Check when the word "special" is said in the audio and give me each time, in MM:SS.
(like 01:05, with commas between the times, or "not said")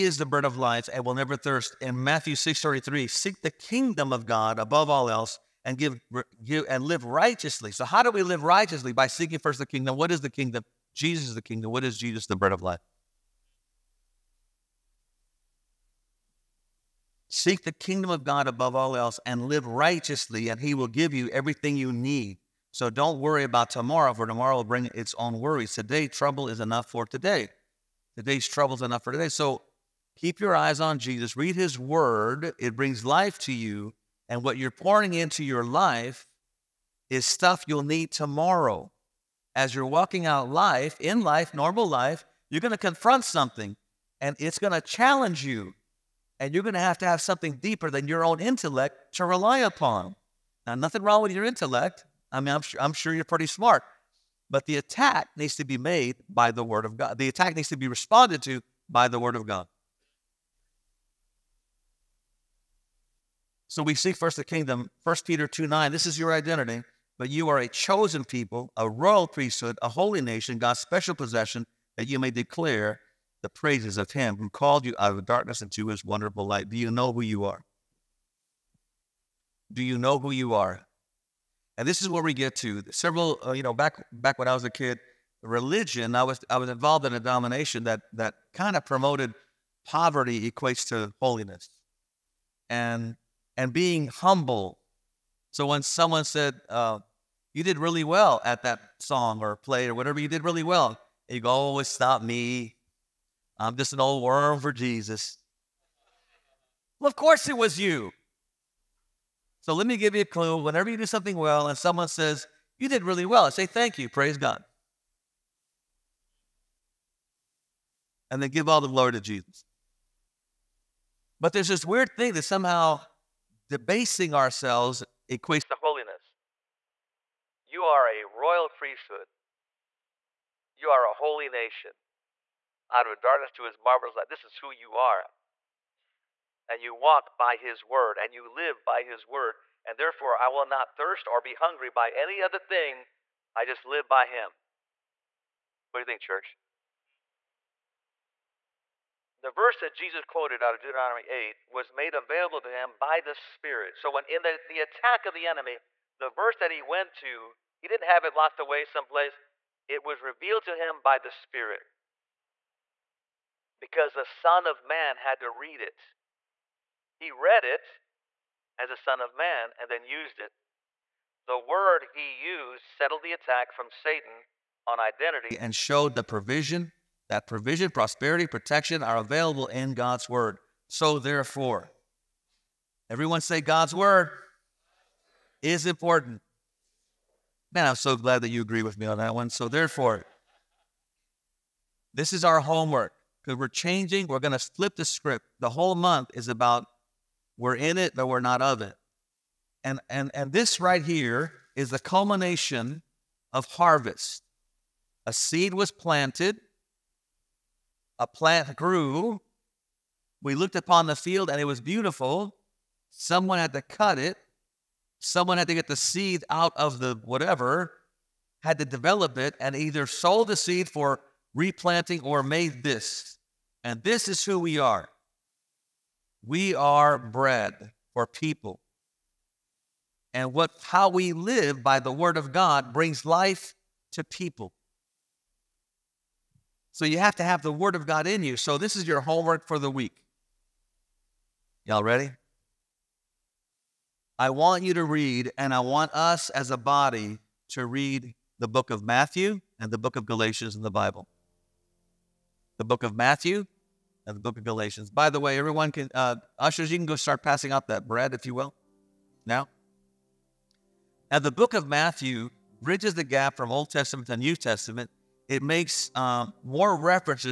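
01:10.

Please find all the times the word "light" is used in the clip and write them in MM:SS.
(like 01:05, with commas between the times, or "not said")
01:16, 02:14.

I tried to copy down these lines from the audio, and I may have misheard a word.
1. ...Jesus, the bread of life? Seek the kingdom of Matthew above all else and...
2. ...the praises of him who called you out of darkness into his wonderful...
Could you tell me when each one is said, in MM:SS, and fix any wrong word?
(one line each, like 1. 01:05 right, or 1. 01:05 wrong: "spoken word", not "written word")
1. 00:11 wrong: "God", not "Matthew"
2. 01:13 right.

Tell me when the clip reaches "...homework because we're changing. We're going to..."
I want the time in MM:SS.
03:12.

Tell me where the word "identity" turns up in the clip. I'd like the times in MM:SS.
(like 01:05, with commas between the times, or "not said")
01:06, 02:54.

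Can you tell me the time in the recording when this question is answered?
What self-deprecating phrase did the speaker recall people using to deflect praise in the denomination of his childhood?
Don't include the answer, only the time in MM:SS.
01:43.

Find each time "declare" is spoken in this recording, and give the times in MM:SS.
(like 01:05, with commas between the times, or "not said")
01:12.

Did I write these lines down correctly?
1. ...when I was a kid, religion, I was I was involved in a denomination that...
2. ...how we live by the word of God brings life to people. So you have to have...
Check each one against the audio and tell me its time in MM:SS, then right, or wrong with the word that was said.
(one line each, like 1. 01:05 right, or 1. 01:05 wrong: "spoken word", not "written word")
1. 01:24 right
2. 03:50 right.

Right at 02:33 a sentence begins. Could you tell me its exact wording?
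So when in the, the attack of the enemy, the verse that he went to, he didn't have it locked away someplace.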